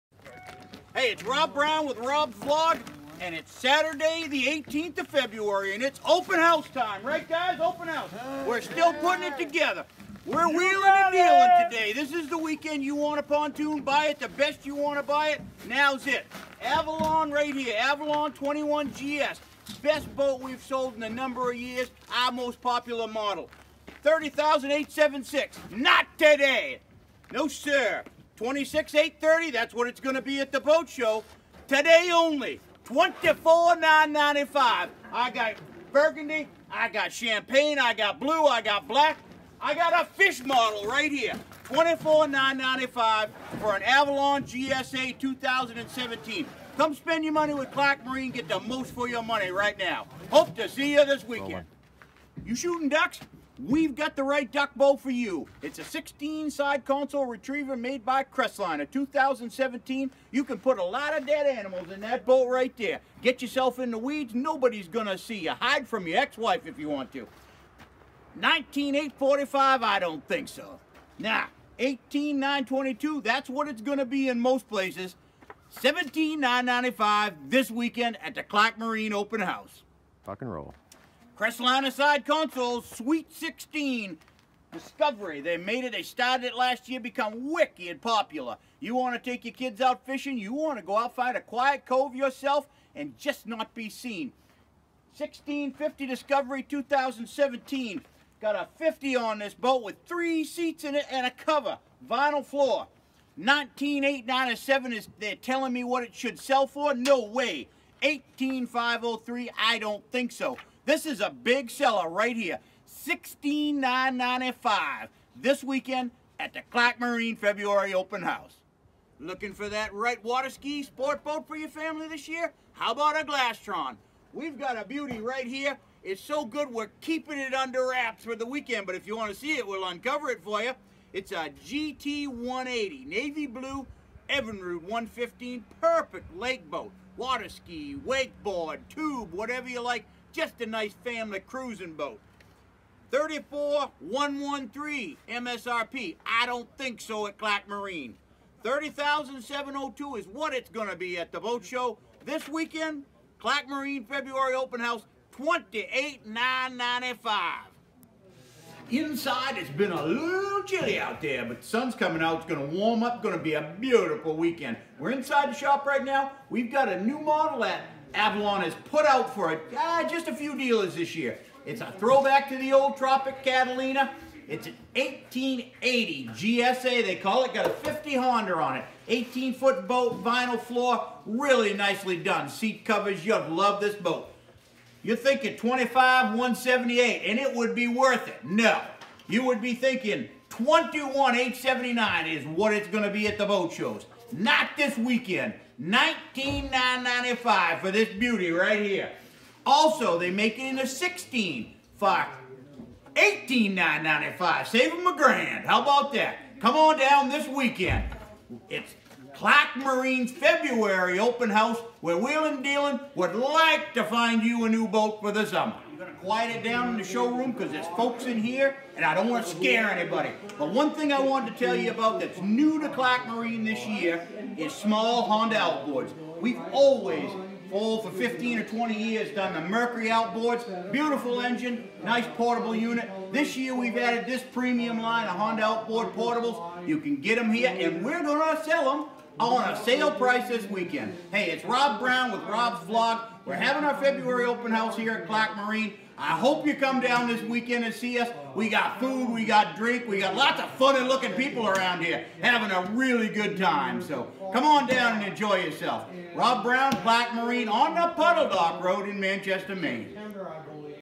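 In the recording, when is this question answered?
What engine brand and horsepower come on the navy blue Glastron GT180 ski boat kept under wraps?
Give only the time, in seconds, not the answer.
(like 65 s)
134 s.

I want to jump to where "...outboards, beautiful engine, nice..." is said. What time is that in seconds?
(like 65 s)
230 s.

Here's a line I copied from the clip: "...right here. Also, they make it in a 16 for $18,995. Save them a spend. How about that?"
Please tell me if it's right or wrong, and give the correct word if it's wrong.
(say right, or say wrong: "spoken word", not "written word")
wrong: "grand", not "spend".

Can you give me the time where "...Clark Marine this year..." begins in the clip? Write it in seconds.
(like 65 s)
222 s.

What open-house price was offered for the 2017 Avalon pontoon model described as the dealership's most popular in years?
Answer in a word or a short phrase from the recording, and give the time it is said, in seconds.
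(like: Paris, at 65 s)
$24,995, at 41 s.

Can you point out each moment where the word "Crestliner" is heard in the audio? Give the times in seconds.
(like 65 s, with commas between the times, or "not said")
58 s, 81 s.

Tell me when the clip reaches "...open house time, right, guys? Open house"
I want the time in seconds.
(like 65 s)
6 s.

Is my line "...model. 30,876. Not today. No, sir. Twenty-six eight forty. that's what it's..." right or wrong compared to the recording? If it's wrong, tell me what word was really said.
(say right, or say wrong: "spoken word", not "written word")
wrong: "thirty", not "forty".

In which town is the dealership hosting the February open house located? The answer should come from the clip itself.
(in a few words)
Manchester, Maine.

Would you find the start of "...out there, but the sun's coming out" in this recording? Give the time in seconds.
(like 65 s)
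160 s.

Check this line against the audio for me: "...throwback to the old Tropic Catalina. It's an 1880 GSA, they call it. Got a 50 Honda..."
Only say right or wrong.
right.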